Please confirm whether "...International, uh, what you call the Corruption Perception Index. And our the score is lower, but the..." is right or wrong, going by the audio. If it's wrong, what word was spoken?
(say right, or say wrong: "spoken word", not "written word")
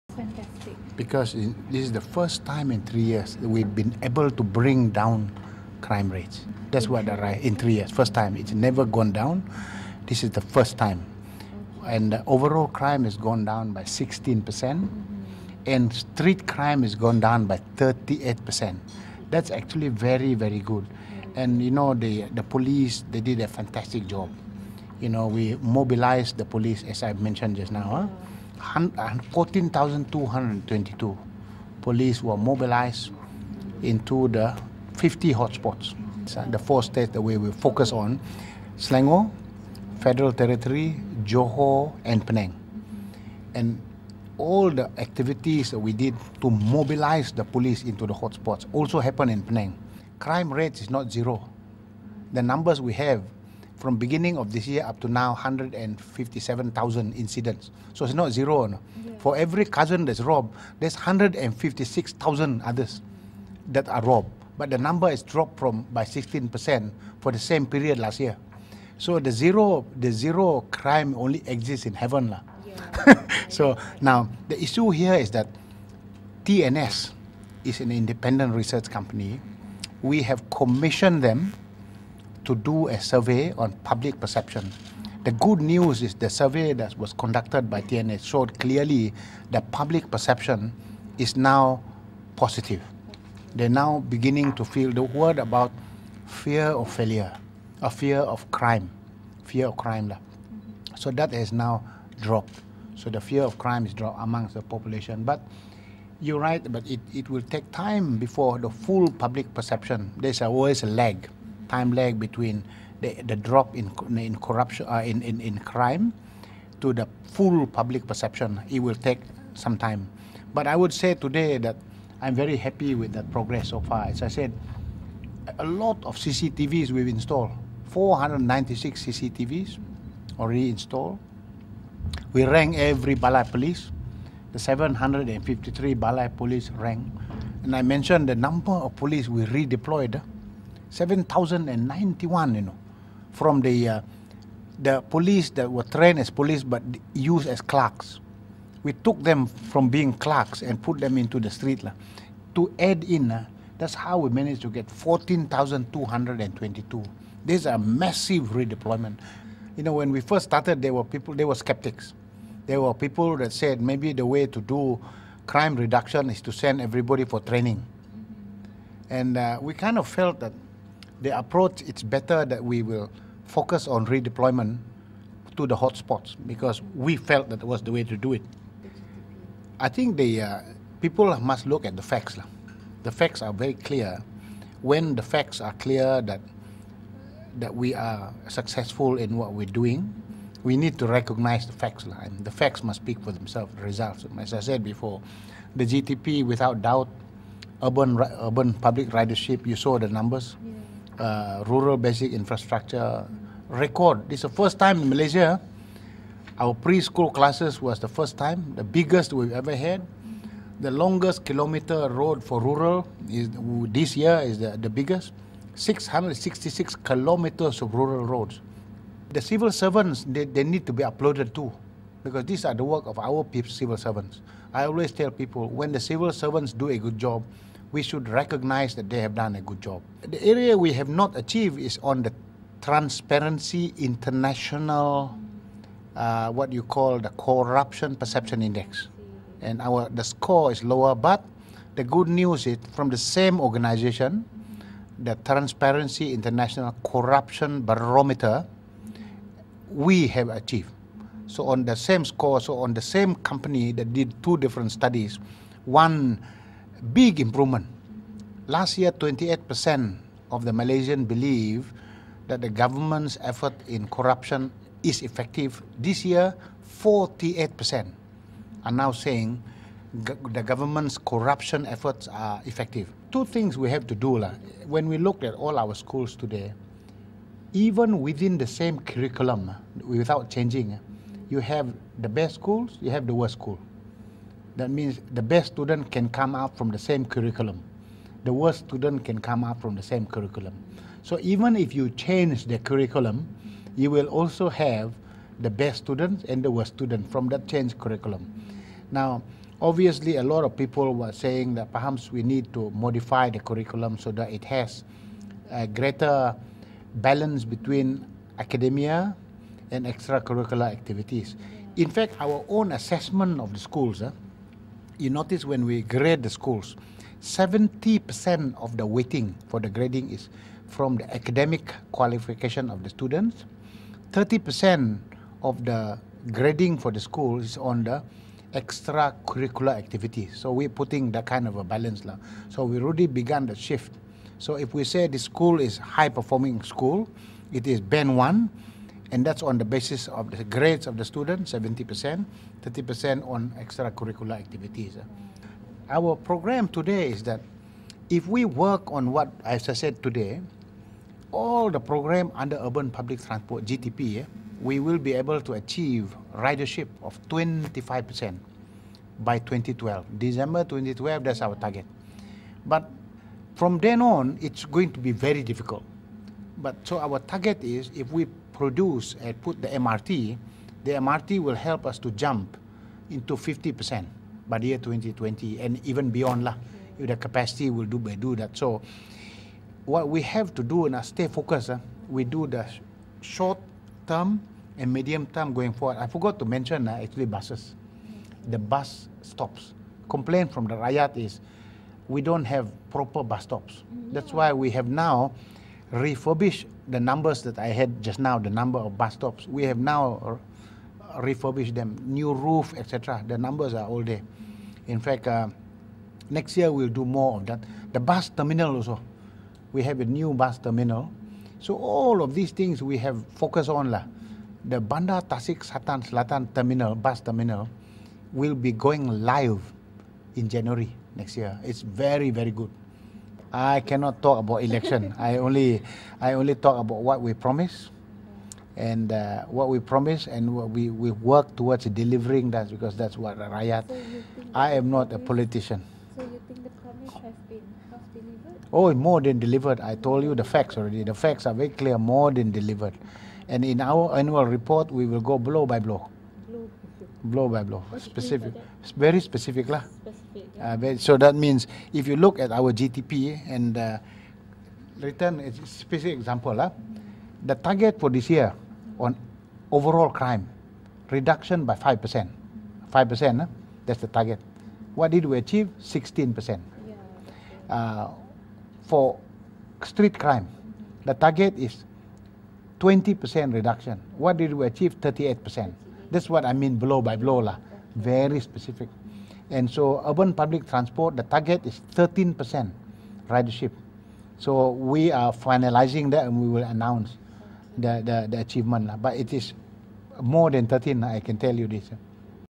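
right.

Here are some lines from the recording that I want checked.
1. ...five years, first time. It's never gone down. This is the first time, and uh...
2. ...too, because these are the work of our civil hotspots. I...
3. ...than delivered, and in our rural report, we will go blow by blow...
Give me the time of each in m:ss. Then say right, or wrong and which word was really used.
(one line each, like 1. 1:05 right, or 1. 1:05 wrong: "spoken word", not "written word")
1. 0:07 wrong: "three", not "five"
2. 3:41 wrong: "servants", not "hotspots"
3. 7:22 wrong: "annual", not "rural".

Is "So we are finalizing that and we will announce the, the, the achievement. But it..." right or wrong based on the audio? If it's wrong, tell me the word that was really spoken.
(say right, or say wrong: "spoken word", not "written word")
right.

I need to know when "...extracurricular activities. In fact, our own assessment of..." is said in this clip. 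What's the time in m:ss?
5:10.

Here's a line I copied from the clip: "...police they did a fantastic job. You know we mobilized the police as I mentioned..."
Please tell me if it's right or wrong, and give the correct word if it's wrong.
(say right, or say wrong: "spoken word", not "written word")
right.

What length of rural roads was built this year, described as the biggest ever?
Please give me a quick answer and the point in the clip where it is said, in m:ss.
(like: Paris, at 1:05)
666 kilometers, at 3:35.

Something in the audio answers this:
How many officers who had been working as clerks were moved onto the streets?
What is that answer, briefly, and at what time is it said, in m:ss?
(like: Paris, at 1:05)
7,091, at 2:20.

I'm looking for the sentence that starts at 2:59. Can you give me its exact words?
I think the uh, people must look at the facts.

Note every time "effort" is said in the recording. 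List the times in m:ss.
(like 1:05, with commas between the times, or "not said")
4:23, 4:31.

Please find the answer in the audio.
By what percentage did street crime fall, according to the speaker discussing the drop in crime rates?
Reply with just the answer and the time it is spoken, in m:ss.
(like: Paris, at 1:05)
38%, at 0:15.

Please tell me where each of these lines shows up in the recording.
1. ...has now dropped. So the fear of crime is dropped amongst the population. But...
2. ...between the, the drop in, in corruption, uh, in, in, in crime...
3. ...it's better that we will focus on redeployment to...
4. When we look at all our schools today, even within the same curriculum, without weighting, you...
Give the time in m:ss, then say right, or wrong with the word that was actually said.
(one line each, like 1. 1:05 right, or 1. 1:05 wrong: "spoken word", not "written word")
1. 1:41 right
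2. 1:52 right
3. 2:51 right
4. 4:34 wrong: "changing", not "weighting".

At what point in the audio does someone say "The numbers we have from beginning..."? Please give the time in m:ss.
0:52.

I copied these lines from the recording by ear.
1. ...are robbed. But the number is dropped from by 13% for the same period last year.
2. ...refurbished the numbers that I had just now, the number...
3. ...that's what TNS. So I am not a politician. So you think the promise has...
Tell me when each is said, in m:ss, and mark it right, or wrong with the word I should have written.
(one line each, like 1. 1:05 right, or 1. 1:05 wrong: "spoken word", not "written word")
1. 1:03 wrong: "16", not "13"
2. 6:36 right
3. 7:13 wrong: "Rakyat", not "TNS".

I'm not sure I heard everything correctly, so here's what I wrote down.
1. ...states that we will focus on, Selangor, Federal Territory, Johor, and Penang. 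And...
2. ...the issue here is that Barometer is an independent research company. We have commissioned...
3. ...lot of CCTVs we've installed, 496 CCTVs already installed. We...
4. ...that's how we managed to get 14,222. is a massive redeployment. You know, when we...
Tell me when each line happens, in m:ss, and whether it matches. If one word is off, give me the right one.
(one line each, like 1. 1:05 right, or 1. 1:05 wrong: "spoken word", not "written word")
1. 0:36 right
2. 1:14 wrong: "TNS", not "Barometer"
3. 2:05 right
4. 2:33 right.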